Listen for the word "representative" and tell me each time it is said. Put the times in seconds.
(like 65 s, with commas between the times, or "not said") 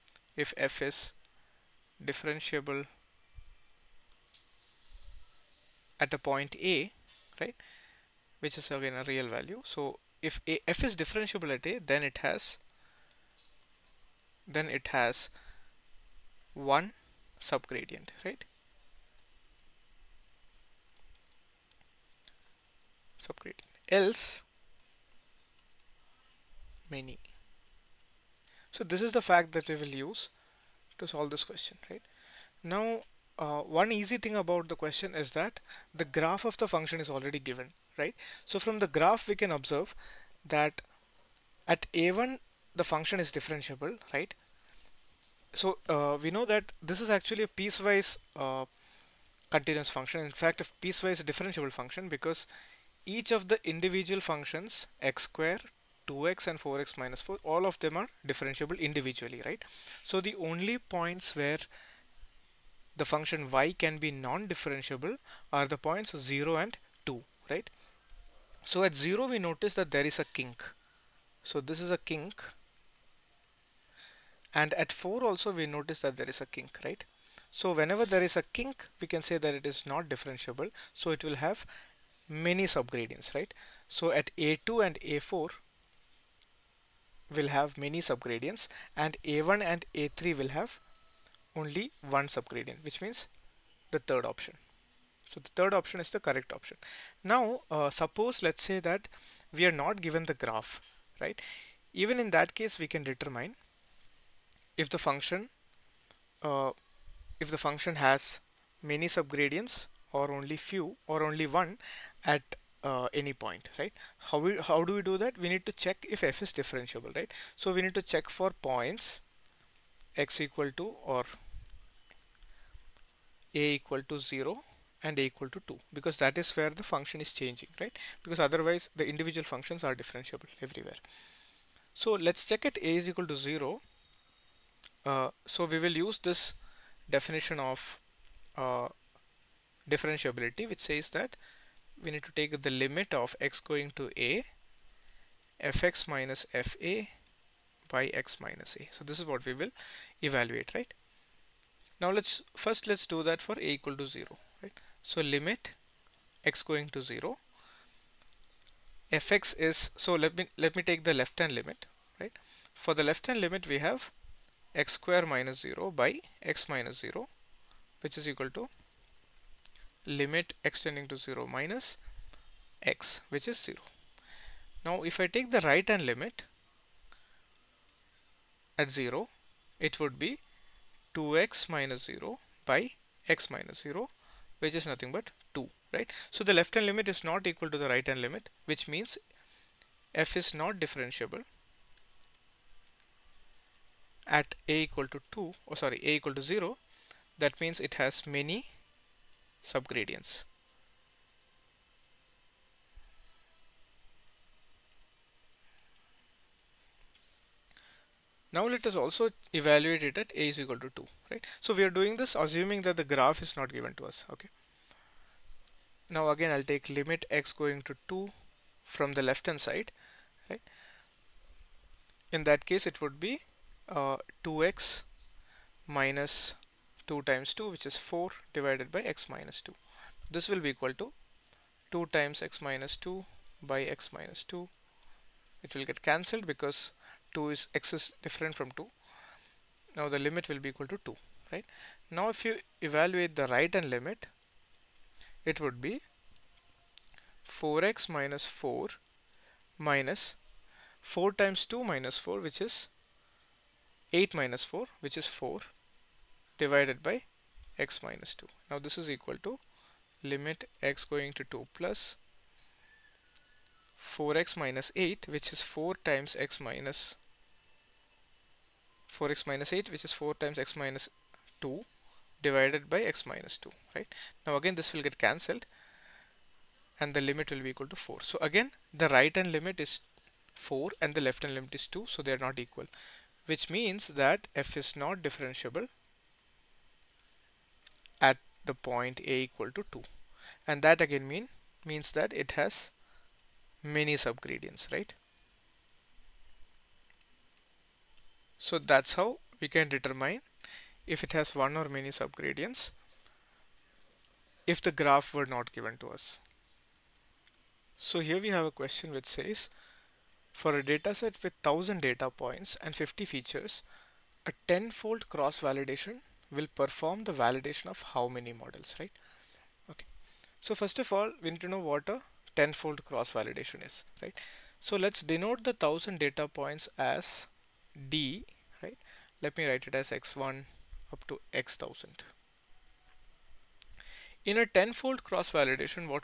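not said.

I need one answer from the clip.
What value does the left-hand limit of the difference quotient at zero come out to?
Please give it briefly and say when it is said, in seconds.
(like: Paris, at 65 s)
0, at 173 s.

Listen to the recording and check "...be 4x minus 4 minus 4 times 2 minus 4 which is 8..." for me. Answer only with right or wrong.
right.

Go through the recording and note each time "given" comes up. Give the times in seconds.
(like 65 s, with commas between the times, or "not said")
37 s, 100 s, 213 s, 305 s.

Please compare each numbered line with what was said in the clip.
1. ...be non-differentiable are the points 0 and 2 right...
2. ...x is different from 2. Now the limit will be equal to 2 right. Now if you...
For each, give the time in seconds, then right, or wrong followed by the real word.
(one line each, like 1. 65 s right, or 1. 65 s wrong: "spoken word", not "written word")
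1. 63 s right
2. 237 s right.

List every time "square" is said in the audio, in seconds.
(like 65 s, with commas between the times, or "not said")
55 s, 164 s.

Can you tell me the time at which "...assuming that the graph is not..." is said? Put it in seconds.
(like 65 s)
212 s.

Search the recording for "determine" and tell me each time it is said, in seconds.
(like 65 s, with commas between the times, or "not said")
103 s, 299 s.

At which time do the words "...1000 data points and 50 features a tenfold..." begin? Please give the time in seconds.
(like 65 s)
311 s.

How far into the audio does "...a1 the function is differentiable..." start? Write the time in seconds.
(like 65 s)
41 s.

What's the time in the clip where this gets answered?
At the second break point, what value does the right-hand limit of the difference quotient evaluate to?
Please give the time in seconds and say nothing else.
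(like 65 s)
277 s.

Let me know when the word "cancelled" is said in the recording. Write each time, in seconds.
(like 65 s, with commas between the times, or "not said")
236 s, 275 s.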